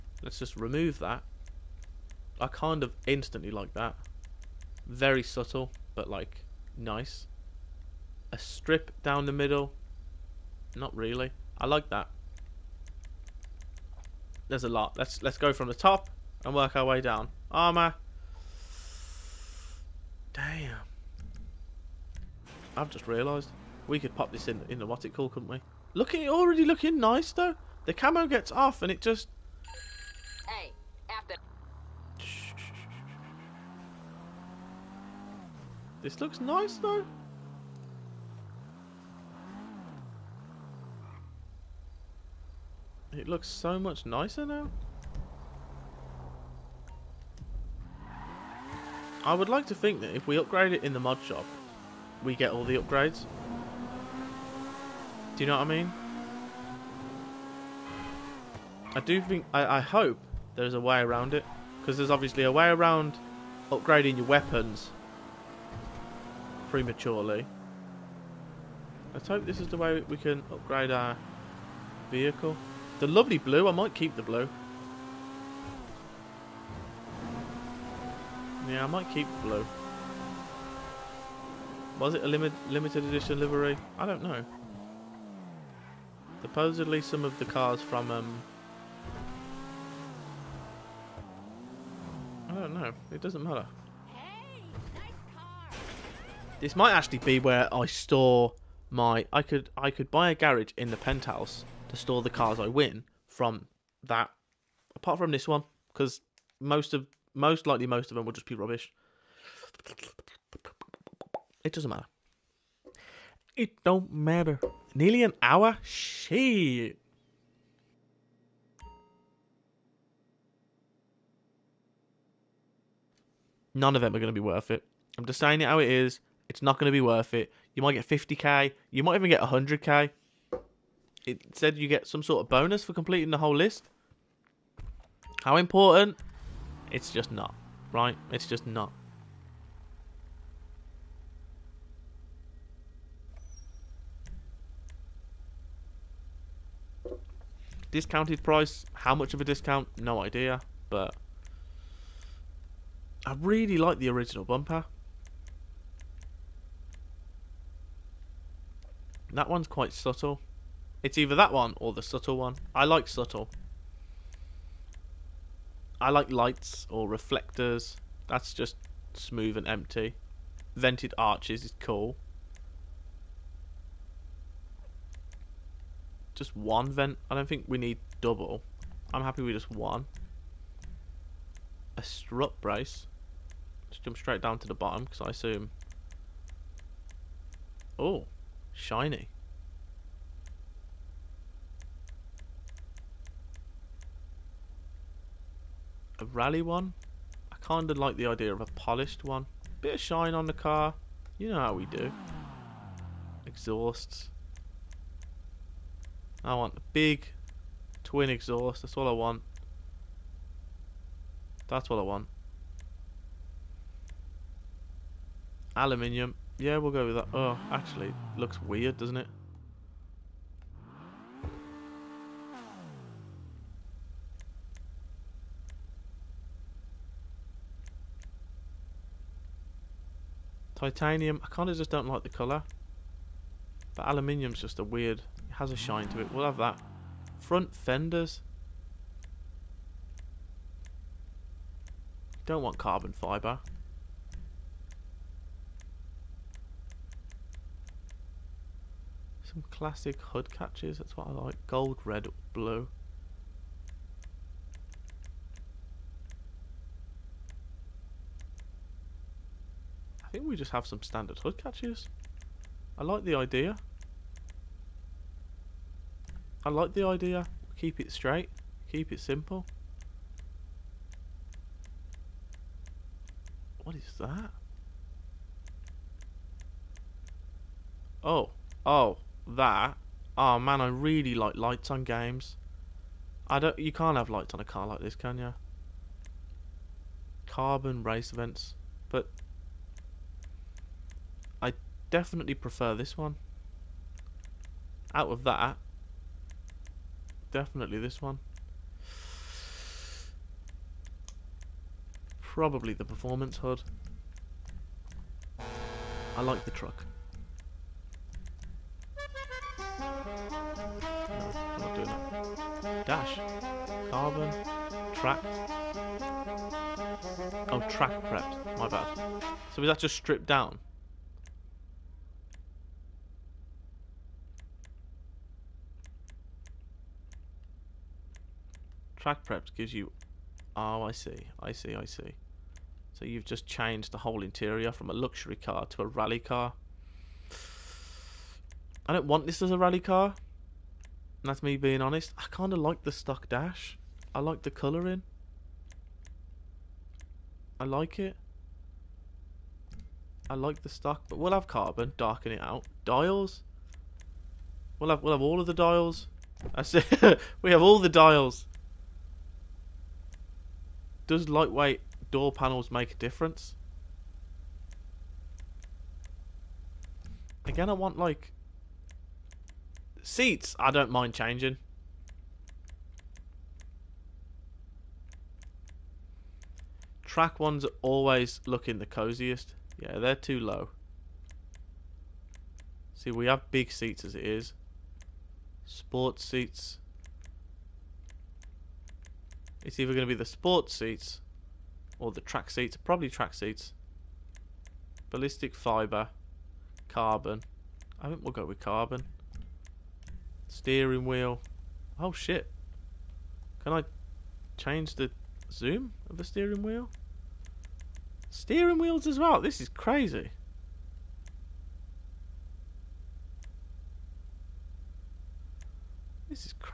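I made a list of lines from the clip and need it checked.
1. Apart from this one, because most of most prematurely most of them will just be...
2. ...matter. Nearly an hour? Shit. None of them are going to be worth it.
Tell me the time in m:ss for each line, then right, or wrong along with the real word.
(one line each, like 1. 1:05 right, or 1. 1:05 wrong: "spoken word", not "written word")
1. 1:44 wrong: "likely", not "prematurely"
2. 1:54 right.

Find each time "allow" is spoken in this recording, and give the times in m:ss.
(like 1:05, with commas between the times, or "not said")
not said.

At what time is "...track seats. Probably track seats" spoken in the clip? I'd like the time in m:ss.
6:32.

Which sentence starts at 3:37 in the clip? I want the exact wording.
Oh, actually, looks weird, doesn't it?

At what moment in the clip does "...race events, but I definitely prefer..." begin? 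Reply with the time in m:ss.
4:48.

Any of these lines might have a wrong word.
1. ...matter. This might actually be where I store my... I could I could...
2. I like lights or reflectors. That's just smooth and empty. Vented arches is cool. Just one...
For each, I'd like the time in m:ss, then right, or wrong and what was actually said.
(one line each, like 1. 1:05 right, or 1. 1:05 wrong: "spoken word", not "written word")
1. 1:33 right
2. 2:46 right.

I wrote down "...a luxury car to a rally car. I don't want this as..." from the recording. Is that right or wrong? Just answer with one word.
right.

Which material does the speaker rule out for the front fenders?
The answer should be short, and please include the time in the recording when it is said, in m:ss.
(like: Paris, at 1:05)
Carbon fibre, at 4:02.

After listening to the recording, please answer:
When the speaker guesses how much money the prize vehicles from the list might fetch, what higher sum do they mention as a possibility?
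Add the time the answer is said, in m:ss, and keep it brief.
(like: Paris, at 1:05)
100k, at 2:09.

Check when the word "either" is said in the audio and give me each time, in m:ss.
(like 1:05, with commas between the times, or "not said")
2:41, 6:29.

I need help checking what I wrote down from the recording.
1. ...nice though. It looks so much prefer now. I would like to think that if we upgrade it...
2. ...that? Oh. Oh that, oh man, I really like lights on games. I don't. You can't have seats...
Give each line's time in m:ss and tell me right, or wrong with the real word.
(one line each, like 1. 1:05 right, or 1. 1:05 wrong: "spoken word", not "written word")
1. 0:36 wrong: "nicer", not "prefer"
2. 4:34 wrong: "lights", not "seats".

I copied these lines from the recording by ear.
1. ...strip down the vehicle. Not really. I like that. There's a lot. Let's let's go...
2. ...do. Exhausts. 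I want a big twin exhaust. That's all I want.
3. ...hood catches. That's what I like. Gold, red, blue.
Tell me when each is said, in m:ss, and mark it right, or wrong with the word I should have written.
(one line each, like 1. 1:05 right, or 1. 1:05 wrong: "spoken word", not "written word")
1. 0:08 wrong: "middle", not "vehicle"
2. 3:21 right
3. 4:10 right.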